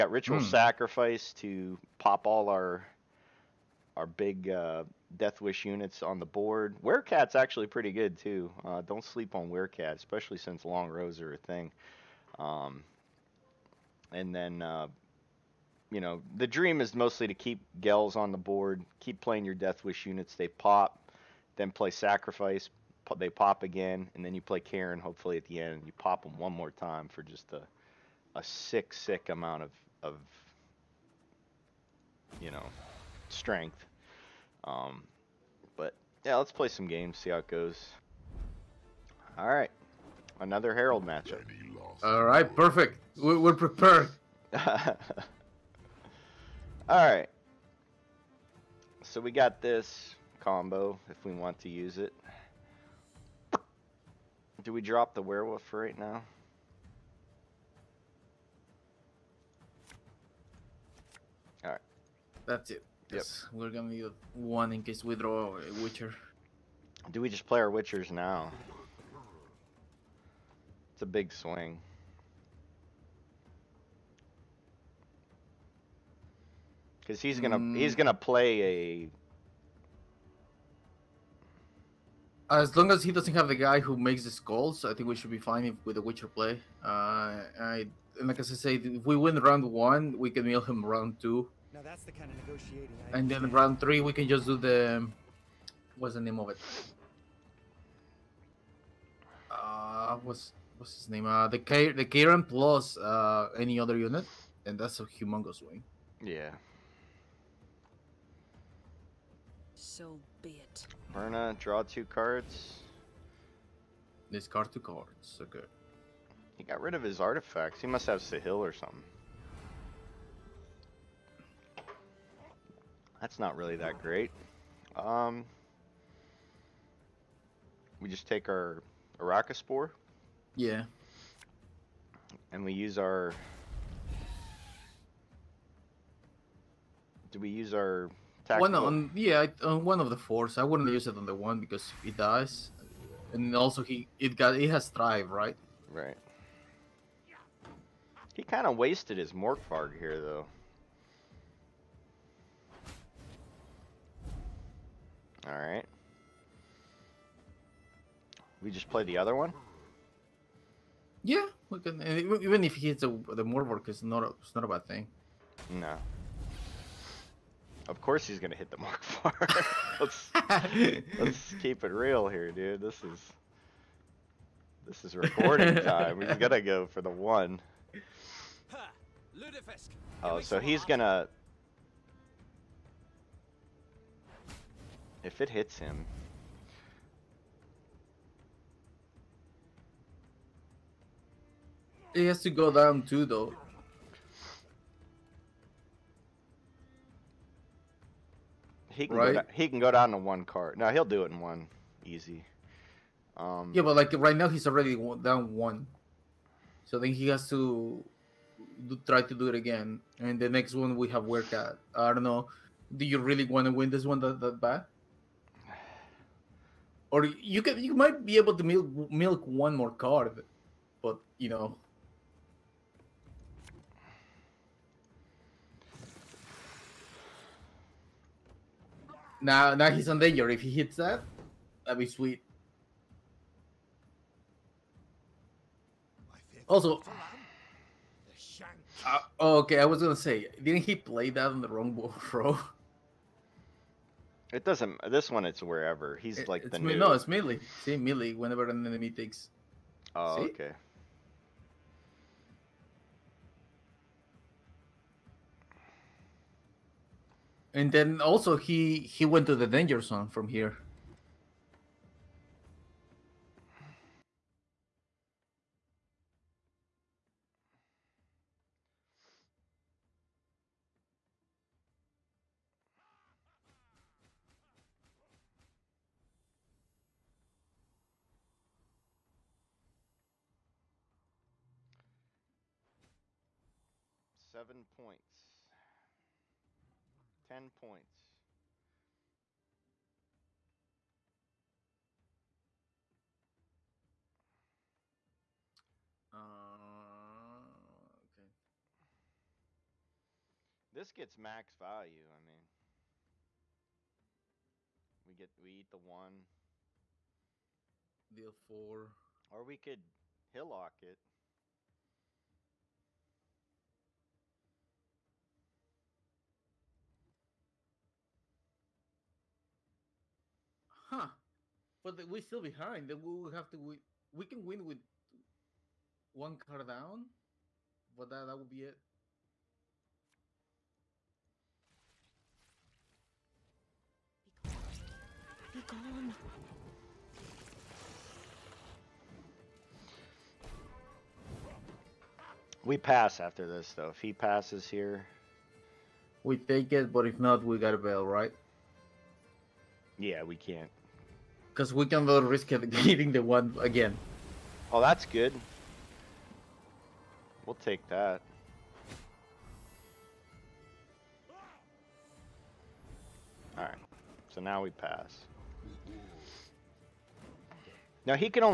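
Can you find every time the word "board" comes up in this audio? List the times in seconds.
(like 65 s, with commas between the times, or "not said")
6 s, 18 s.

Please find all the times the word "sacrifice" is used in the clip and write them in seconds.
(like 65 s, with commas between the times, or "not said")
0 s, 21 s.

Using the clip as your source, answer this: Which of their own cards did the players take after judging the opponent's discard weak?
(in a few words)
Archespore.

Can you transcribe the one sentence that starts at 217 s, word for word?
or you can you might be able to milk milk one more card, but you know.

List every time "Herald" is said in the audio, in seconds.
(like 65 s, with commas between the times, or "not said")
40 s.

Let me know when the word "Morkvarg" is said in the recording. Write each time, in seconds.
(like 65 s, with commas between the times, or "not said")
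149 s, 163 s.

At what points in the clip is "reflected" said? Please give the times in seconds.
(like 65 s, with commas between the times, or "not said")
not said.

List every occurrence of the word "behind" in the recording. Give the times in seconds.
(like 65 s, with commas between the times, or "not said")
322 s.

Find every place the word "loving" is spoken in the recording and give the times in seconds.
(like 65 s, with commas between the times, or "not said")
not said.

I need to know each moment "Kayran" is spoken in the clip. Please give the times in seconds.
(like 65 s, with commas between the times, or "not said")
24 s, 102 s.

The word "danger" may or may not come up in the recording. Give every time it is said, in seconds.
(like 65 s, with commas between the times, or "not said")
230 s, 259 s.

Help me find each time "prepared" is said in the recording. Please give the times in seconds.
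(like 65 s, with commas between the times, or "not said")
43 s.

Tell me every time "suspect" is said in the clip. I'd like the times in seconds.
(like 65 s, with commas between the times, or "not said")
not said.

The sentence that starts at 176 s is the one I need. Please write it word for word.
we going gotta go for the one.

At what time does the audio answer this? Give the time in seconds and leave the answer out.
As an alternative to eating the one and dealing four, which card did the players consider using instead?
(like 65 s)
310 s.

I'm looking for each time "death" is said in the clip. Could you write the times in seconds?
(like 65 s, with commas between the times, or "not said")
5 s, 19 s.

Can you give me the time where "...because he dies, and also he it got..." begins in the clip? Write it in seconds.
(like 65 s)
141 s.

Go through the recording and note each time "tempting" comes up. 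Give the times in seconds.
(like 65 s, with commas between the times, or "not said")
not said.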